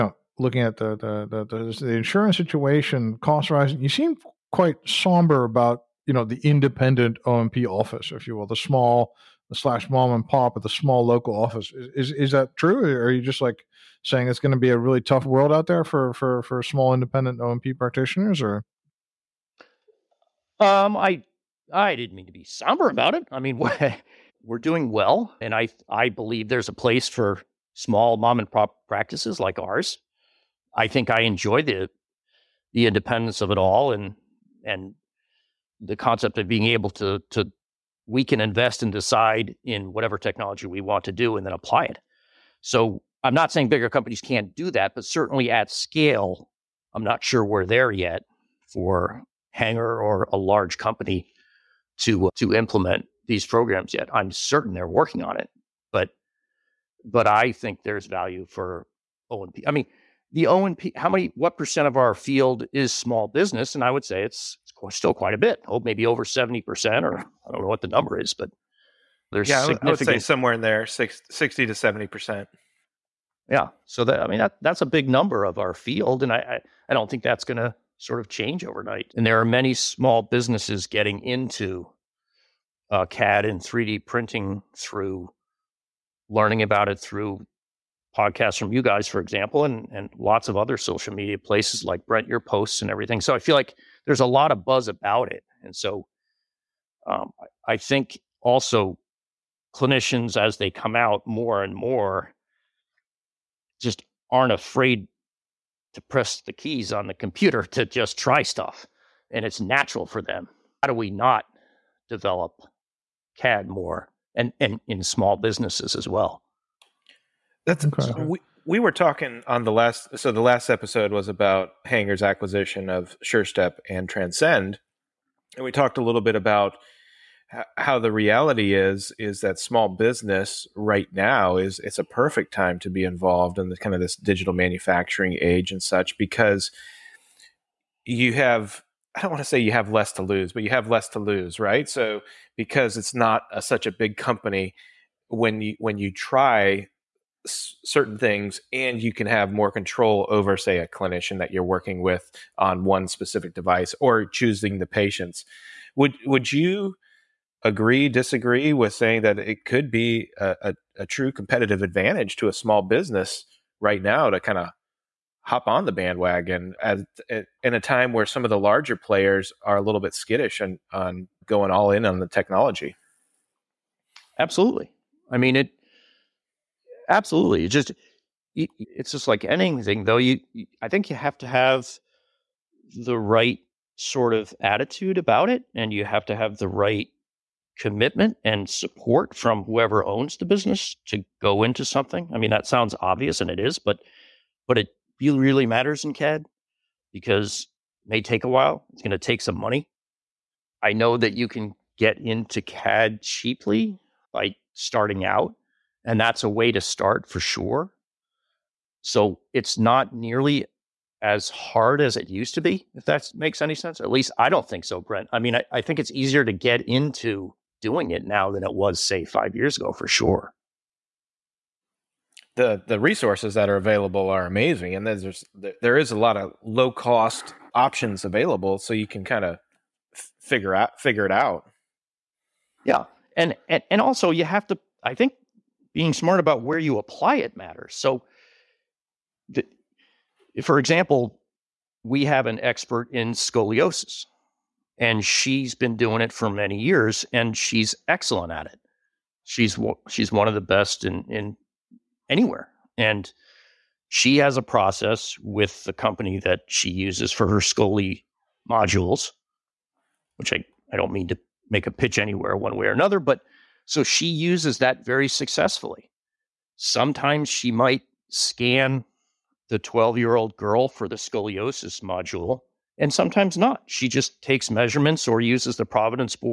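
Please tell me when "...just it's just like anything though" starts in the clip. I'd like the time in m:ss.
2:57.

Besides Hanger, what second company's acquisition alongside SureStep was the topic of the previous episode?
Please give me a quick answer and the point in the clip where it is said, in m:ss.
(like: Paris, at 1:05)
Transcend, at 2:04.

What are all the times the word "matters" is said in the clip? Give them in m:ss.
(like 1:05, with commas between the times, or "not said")
3:15, 3:57.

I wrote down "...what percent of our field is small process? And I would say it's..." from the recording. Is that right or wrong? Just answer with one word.
wrong.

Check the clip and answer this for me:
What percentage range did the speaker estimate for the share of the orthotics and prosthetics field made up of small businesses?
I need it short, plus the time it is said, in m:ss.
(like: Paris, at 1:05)
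60 to 70 percent, at 1:10.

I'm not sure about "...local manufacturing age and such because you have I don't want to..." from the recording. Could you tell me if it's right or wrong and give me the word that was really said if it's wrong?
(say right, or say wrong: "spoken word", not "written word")
wrong: "digital", not "local".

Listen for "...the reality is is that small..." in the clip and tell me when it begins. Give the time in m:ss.
2:07.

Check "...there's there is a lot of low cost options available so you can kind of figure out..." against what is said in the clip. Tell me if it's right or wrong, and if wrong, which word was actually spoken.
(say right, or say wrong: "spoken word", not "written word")
right.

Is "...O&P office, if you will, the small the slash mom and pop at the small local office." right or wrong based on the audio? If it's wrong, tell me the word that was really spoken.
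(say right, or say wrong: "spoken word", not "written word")
right.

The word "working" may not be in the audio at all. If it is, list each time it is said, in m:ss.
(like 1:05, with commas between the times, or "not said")
0:54, 2:31.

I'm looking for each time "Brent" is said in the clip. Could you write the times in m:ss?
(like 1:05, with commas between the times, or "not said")
1:32, 3:35.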